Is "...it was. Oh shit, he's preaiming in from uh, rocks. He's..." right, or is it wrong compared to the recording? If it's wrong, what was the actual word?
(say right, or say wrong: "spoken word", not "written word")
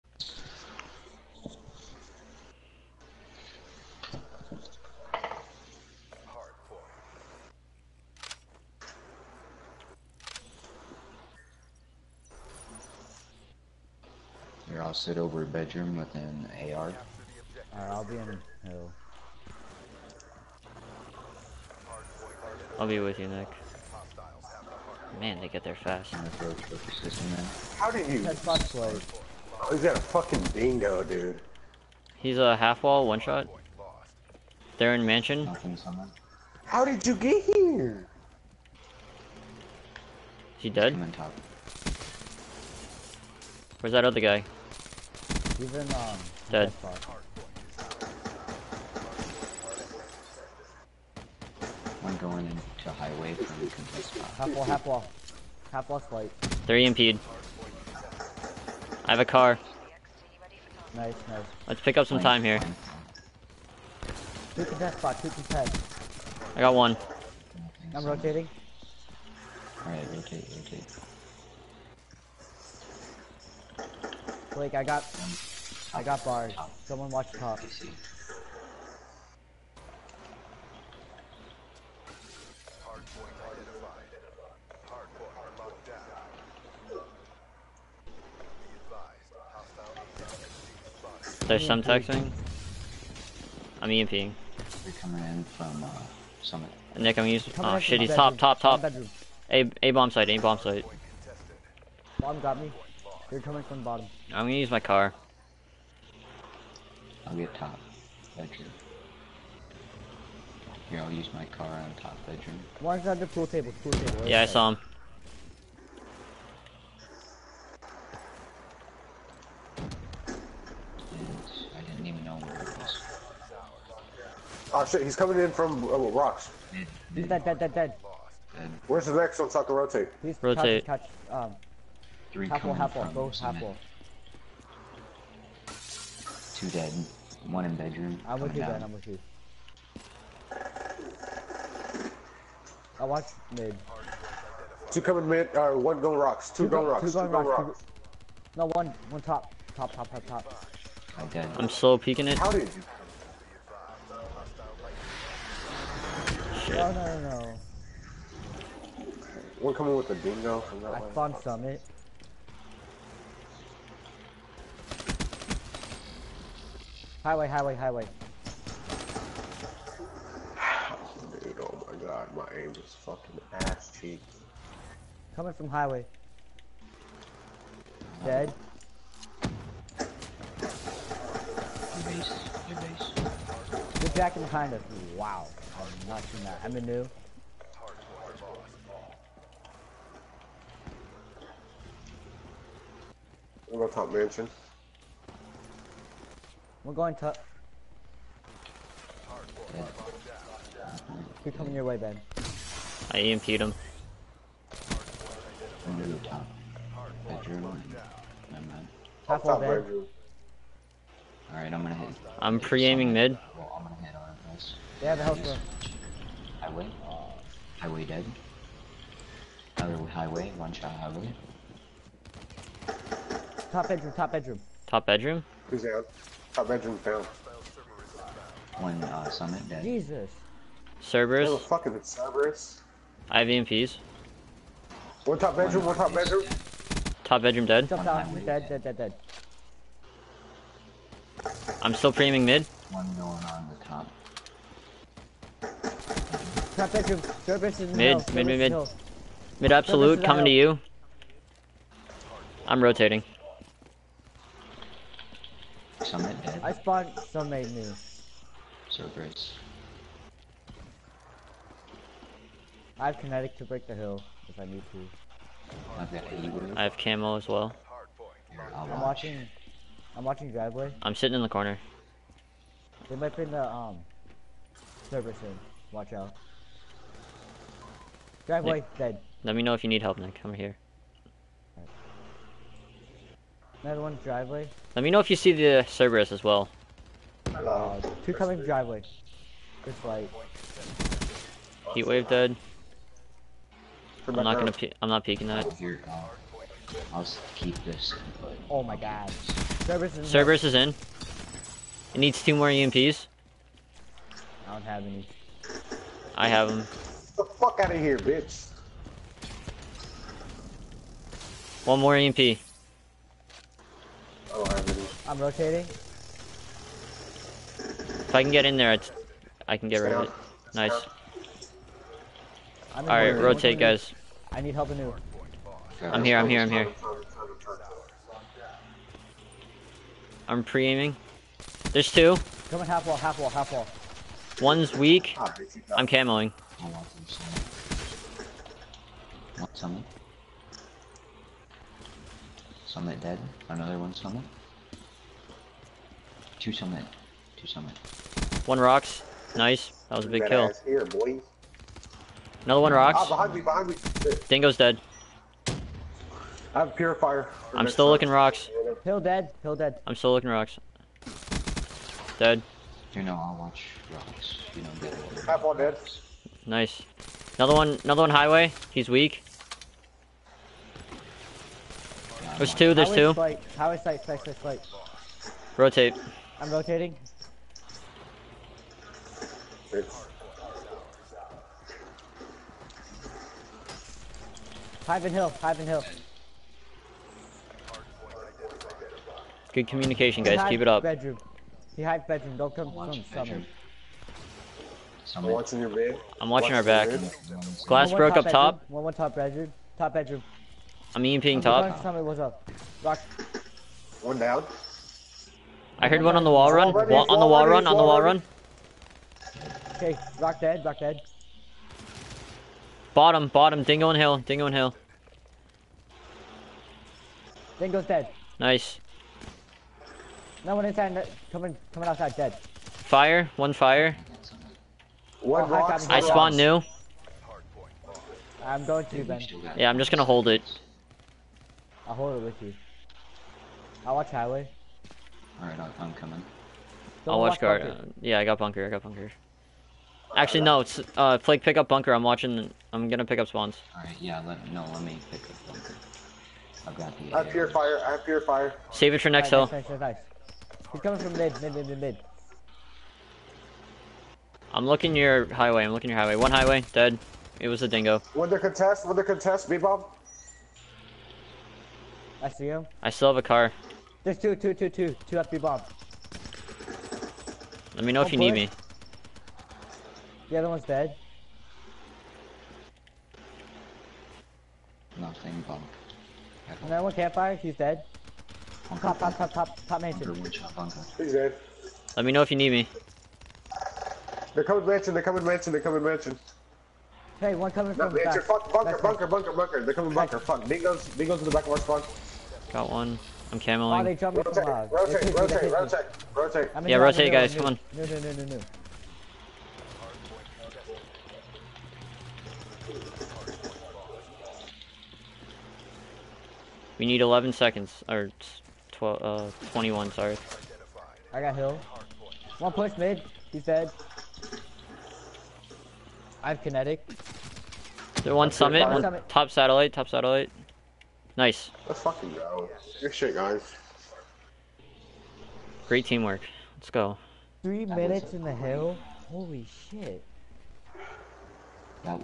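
wrong: "coming", not "preaiming".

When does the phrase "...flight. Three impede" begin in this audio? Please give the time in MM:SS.
00:55.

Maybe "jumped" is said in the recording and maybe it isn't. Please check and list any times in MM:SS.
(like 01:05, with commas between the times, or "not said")
08:14.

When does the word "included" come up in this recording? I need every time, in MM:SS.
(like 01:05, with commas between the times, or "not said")
not said.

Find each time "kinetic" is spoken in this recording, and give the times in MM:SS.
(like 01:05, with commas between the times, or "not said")
04:23, 08:36.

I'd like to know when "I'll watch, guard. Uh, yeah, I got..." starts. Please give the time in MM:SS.
07:17.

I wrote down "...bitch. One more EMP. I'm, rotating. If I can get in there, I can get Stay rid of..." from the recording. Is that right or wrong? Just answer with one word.
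right.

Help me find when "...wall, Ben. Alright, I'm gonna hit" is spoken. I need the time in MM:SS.
03:29.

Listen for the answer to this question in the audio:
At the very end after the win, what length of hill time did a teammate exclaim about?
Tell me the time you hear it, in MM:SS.
08:47.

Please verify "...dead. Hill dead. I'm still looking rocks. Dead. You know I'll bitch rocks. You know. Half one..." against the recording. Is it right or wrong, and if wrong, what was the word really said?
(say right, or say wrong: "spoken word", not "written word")
wrong: "watch", not "bitch".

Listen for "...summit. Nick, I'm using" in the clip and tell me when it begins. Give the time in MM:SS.
01:36.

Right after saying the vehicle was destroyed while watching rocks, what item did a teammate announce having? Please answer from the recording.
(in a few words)
purifier.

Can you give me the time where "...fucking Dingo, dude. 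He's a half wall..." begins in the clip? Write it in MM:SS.
00:30.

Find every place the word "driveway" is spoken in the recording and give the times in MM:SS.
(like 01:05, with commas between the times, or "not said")
04:30, 04:38, 04:44, 04:48.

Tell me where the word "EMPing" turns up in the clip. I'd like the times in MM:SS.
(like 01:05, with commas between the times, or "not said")
01:33, 06:41.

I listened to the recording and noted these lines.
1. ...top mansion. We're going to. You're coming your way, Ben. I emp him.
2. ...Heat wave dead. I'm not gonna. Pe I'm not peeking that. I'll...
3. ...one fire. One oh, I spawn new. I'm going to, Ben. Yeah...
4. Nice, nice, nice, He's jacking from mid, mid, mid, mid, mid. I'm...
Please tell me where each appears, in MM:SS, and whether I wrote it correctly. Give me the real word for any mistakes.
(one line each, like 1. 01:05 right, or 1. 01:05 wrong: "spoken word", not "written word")
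1. 03:13 right
2. 04:51 right
3. 07:03 right
4. 07:29 wrong: "coming", not "jacking".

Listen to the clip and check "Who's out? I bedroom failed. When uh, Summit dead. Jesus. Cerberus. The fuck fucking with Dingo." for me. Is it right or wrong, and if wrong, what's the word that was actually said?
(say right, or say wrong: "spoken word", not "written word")
wrong: "Cerberus", not "Dingo".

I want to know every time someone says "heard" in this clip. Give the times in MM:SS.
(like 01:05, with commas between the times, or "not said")
06:46.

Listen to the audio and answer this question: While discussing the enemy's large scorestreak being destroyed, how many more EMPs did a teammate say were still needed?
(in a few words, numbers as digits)
2.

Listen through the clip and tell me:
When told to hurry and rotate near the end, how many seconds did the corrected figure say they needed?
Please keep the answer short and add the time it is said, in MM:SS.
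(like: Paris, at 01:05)
21, at 08:29.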